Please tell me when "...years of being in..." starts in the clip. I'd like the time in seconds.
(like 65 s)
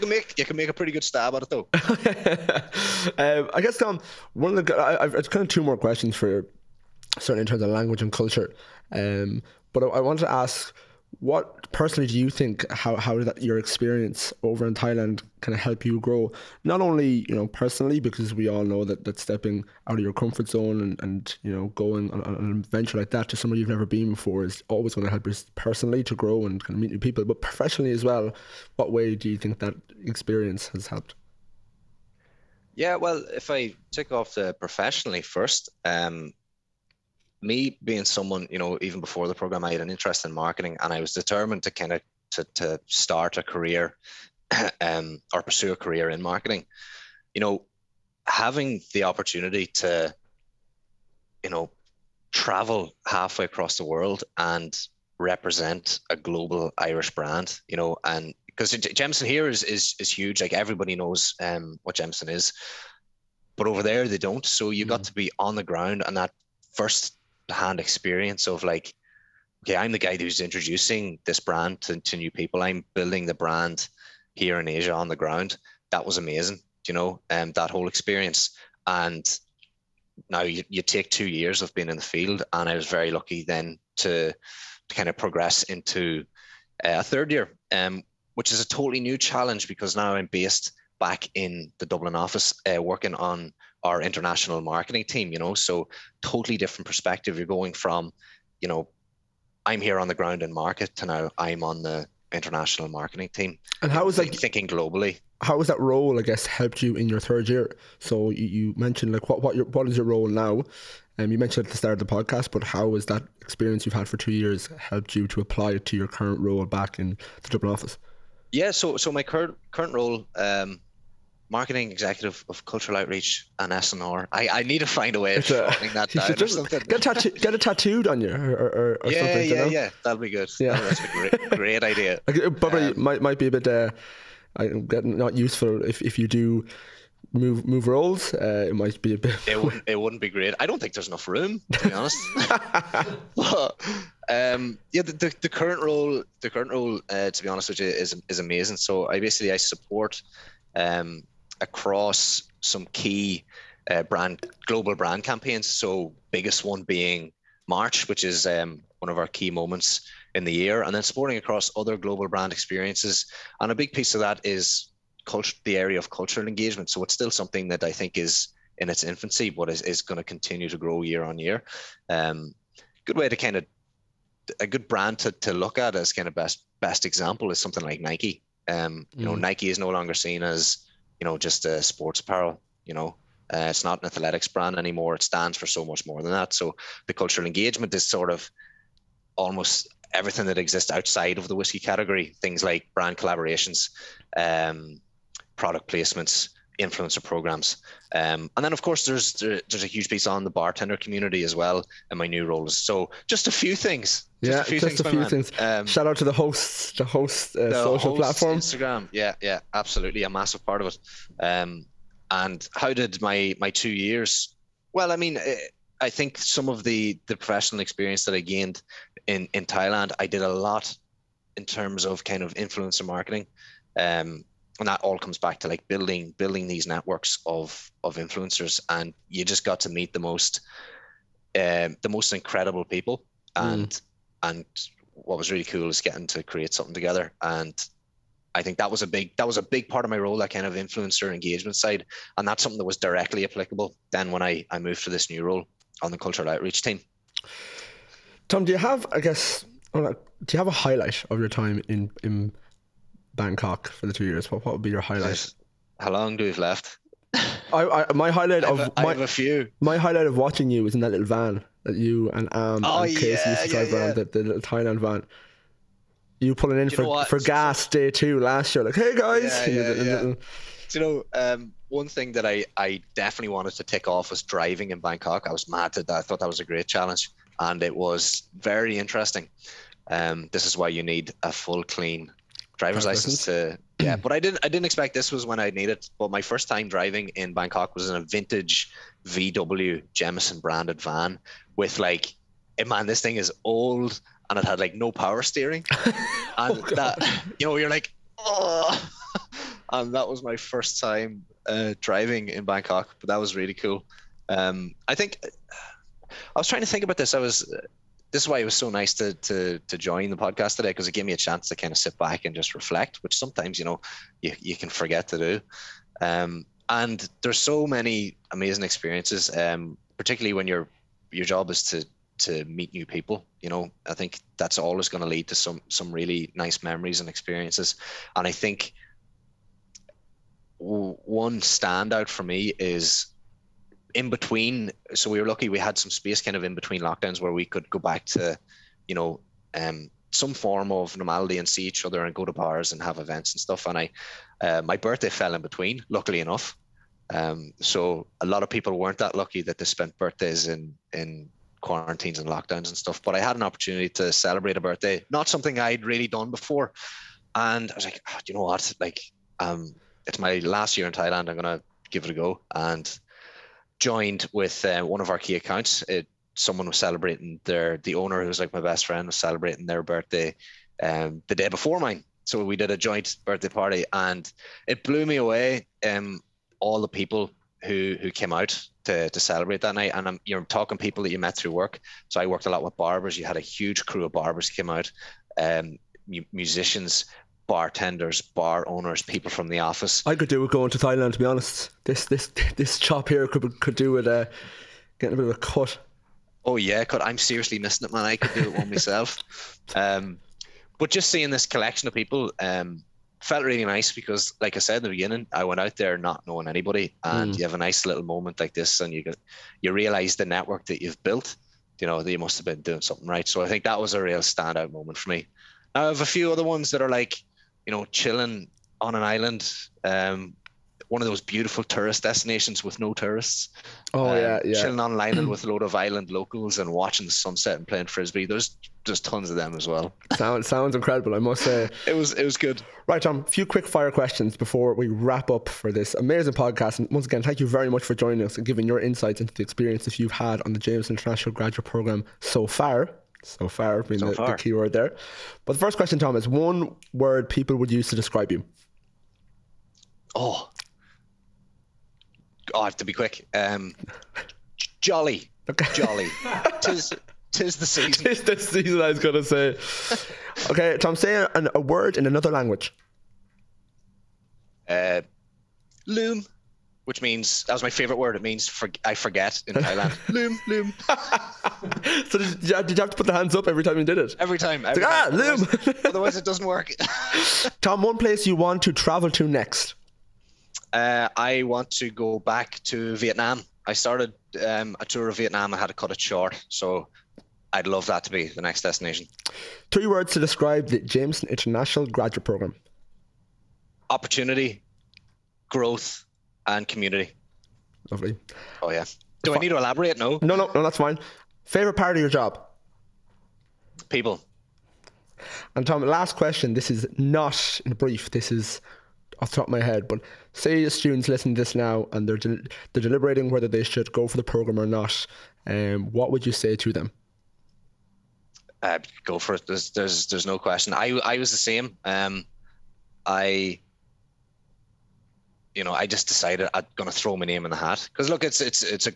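81 s.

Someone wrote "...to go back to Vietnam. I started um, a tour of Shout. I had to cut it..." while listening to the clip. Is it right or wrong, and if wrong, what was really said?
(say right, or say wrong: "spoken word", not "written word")
wrong: "Vietnam", not "Shout".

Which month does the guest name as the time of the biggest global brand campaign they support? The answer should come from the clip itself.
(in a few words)
March.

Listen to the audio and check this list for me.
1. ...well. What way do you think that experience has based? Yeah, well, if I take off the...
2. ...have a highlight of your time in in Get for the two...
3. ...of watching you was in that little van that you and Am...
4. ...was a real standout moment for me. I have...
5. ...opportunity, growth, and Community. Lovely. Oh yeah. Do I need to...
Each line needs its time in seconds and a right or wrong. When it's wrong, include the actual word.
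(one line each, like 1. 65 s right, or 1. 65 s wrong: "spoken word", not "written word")
1. 28 s wrong: "helped", not "based"
2. 250 s wrong: "Bangkok", not "Get"
3. 260 s right
4. 413 s right
5. 494 s right.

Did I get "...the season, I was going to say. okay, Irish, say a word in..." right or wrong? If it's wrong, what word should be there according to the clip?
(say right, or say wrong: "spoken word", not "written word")
wrong: "Tom", not "Irish".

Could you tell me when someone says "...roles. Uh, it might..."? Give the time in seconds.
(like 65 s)
137 s.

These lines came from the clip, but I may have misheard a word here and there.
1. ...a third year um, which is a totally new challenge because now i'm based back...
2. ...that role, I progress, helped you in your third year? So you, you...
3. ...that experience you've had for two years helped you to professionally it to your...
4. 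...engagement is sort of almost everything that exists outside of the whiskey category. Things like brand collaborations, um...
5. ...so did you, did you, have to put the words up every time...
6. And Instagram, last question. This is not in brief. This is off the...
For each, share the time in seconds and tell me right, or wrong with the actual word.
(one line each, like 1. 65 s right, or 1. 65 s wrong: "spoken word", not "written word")
1. 86 s right
2. 105 s wrong: "guess", not "progress"
3. 113 s wrong: "apply", not "professionally"
4. 187 s right
5. 472 s wrong: "hands", not "words"
6. 505 s wrong: "Tom", not "Instagram".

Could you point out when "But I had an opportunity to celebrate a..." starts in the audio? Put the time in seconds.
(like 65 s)
353 s.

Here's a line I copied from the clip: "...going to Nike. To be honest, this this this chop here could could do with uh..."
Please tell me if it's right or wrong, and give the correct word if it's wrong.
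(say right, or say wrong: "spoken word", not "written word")
wrong: "Thailand", not "Nike".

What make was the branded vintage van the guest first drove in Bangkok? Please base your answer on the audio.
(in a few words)
VW.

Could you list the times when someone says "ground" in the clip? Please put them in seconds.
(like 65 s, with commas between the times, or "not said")
65 s, 75 s, 100 s.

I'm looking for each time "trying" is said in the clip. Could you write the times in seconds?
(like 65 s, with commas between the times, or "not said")
306 s.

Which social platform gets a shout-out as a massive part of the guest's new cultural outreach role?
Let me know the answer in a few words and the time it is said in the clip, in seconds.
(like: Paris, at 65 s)
Instagram, at 208 s.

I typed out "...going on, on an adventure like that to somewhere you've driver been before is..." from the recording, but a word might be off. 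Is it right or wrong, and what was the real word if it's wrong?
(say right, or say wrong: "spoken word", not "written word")
wrong: "never", not "driver".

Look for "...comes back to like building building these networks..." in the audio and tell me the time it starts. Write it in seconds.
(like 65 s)
225 s.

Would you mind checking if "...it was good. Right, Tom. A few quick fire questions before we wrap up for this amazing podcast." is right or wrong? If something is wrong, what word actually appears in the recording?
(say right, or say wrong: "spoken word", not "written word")
right.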